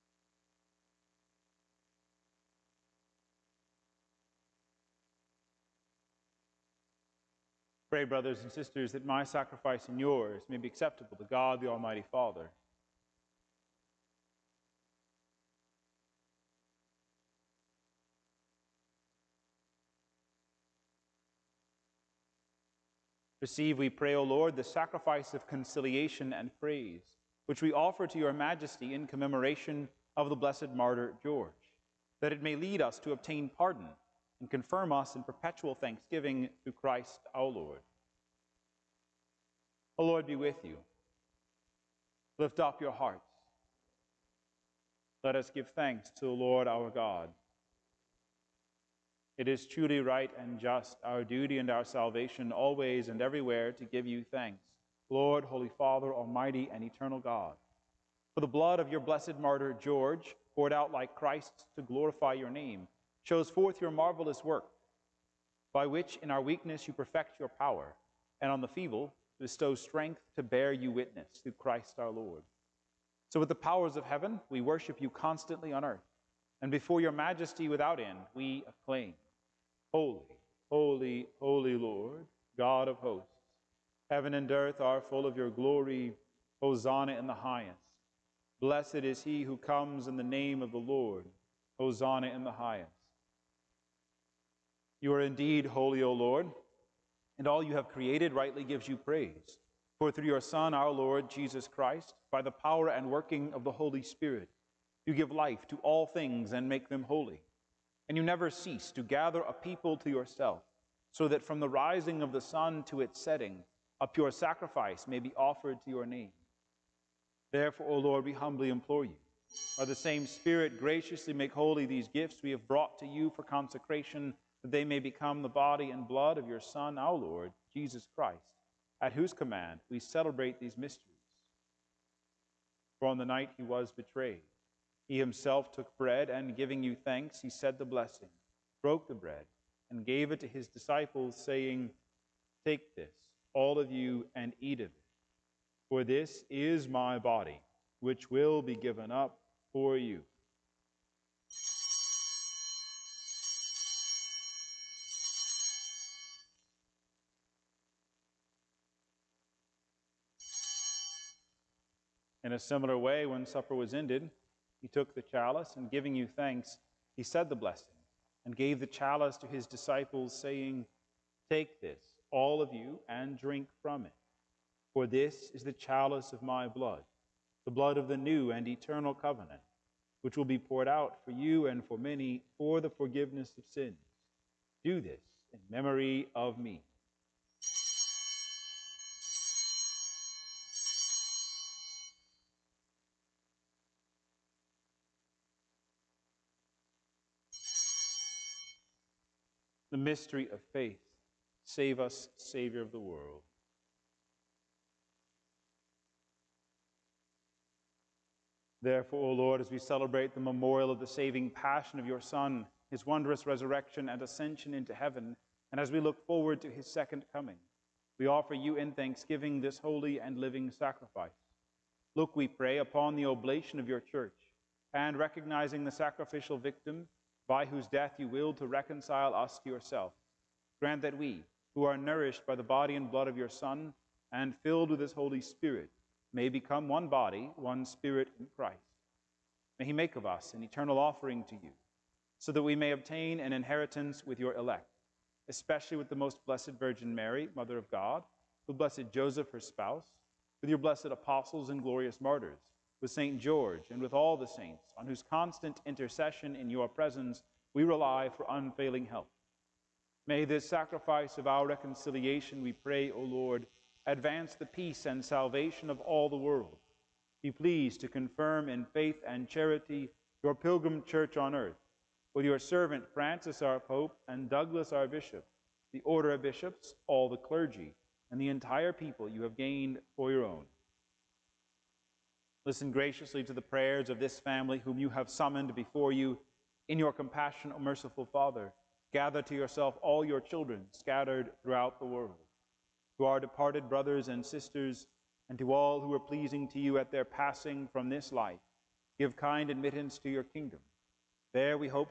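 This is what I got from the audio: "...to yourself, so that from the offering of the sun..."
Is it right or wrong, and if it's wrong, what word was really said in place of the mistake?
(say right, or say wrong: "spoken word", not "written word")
wrong: "rising", not "offering".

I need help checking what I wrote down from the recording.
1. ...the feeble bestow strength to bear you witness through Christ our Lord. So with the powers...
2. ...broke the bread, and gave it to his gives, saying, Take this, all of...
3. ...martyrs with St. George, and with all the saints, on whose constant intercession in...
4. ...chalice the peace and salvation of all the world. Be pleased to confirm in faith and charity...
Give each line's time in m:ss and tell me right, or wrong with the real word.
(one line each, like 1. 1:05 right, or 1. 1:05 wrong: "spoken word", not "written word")
1. 1:08 right
2. 2:18 wrong: "disciples", not "gives"
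3. 4:12 right
4. 4:24 wrong: "advance", not "chalice".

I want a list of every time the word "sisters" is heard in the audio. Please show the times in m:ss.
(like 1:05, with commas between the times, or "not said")
0:08, 4:54.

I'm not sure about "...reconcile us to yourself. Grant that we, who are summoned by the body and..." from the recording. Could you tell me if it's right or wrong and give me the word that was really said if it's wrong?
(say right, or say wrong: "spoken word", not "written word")
wrong: "nourished", not "summoned".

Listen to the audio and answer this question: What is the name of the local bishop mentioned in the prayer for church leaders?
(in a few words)
Douglas.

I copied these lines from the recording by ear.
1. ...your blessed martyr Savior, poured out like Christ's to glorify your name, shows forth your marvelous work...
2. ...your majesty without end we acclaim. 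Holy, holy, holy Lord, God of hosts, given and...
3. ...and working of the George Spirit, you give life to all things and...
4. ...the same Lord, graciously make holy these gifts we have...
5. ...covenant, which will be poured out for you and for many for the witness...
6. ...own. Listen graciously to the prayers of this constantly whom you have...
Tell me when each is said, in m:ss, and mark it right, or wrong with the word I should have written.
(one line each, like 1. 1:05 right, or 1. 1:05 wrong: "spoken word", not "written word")
1. 0:58 wrong: "George", not "Savior"
2. 1:17 wrong: "heaven", not "given"
3. 1:42 wrong: "Holy", not "George"
4. 1:59 wrong: "Spirit", not "Lord"
5. 2:59 wrong: "forgiveness", not "witness"
6. 4:40 wrong: "family", not "constantly".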